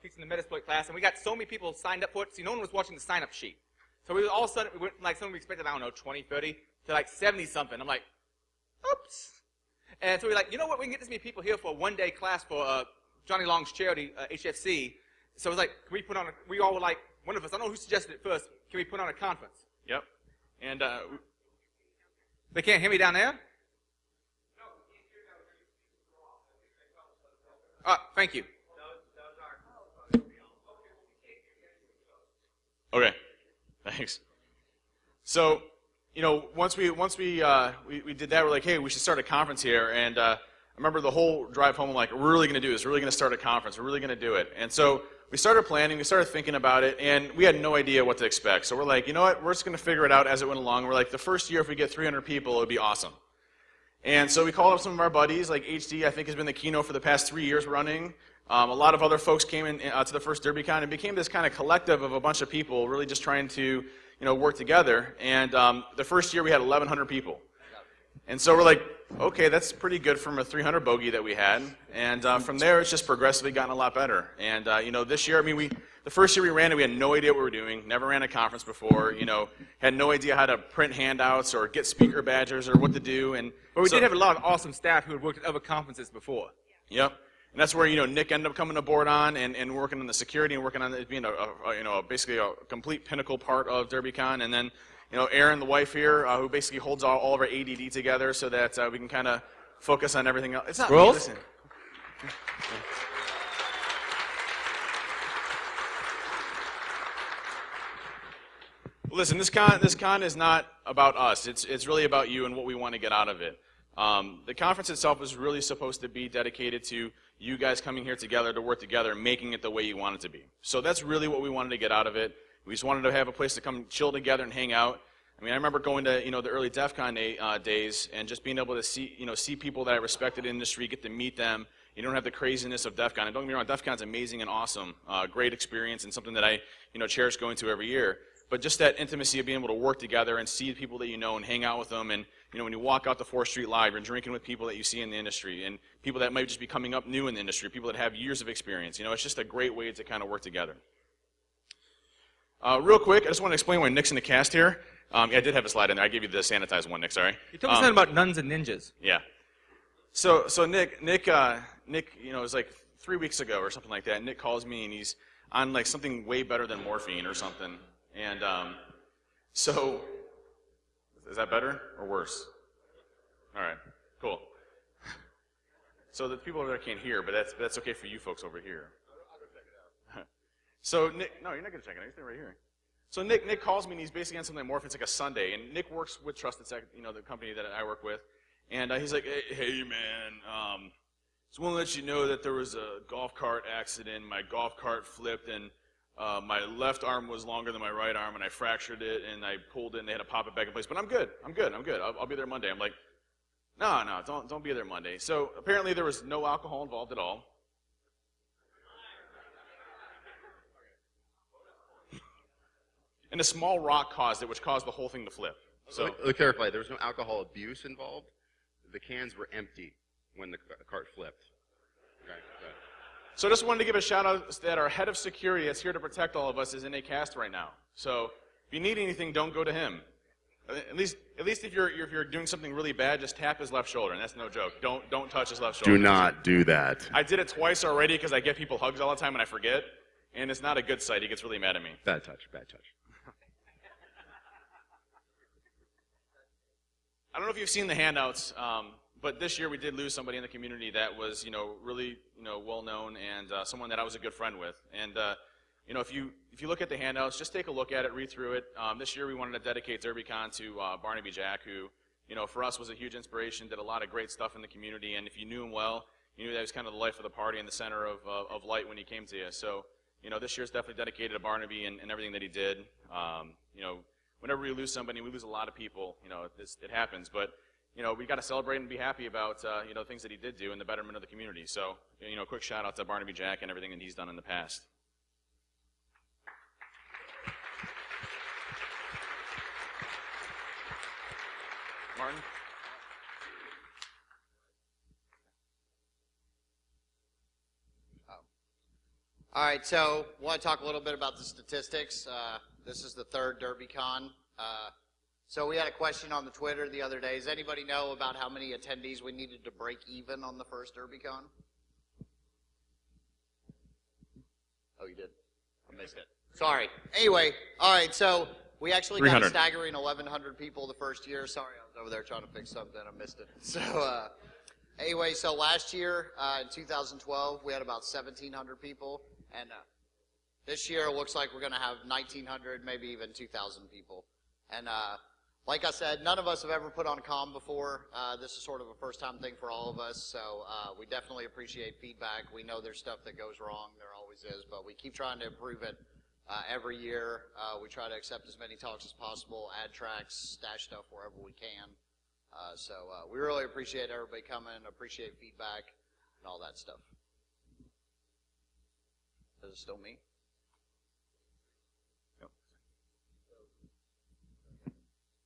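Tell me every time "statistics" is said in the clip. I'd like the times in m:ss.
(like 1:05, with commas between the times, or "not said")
5:01.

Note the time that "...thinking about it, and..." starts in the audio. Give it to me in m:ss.
0:46.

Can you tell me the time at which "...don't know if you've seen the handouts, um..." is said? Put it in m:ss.
4:07.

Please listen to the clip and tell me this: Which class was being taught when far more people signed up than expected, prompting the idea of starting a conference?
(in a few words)
Metasploit.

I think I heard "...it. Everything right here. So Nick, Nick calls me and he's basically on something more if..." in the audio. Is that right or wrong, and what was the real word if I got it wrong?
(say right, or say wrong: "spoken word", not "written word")
right.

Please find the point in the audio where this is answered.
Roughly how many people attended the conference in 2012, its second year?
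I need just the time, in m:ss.
5:28.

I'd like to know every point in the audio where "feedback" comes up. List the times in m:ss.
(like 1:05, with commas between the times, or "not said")
5:41, 5:55.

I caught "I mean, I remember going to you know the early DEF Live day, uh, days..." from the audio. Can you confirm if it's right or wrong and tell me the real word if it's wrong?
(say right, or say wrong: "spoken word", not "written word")
wrong: "CON", not "Live".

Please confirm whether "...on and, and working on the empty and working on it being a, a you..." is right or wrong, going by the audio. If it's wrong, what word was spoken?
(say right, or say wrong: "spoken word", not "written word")
wrong: "security", not "empty".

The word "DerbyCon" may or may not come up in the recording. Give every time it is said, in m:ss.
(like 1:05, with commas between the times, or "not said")
1:00, 1:33, 4:20, 5:03, 5:10.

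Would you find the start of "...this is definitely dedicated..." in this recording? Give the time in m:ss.
4:30.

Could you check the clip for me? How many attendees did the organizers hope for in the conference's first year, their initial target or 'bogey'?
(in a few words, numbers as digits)
300.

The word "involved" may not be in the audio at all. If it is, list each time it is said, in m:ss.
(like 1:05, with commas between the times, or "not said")
3:26, 3:37.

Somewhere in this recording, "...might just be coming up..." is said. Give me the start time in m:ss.
2:26.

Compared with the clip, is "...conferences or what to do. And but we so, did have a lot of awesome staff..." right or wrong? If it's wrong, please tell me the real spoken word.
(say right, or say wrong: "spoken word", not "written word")
wrong: "badges", not "conferences".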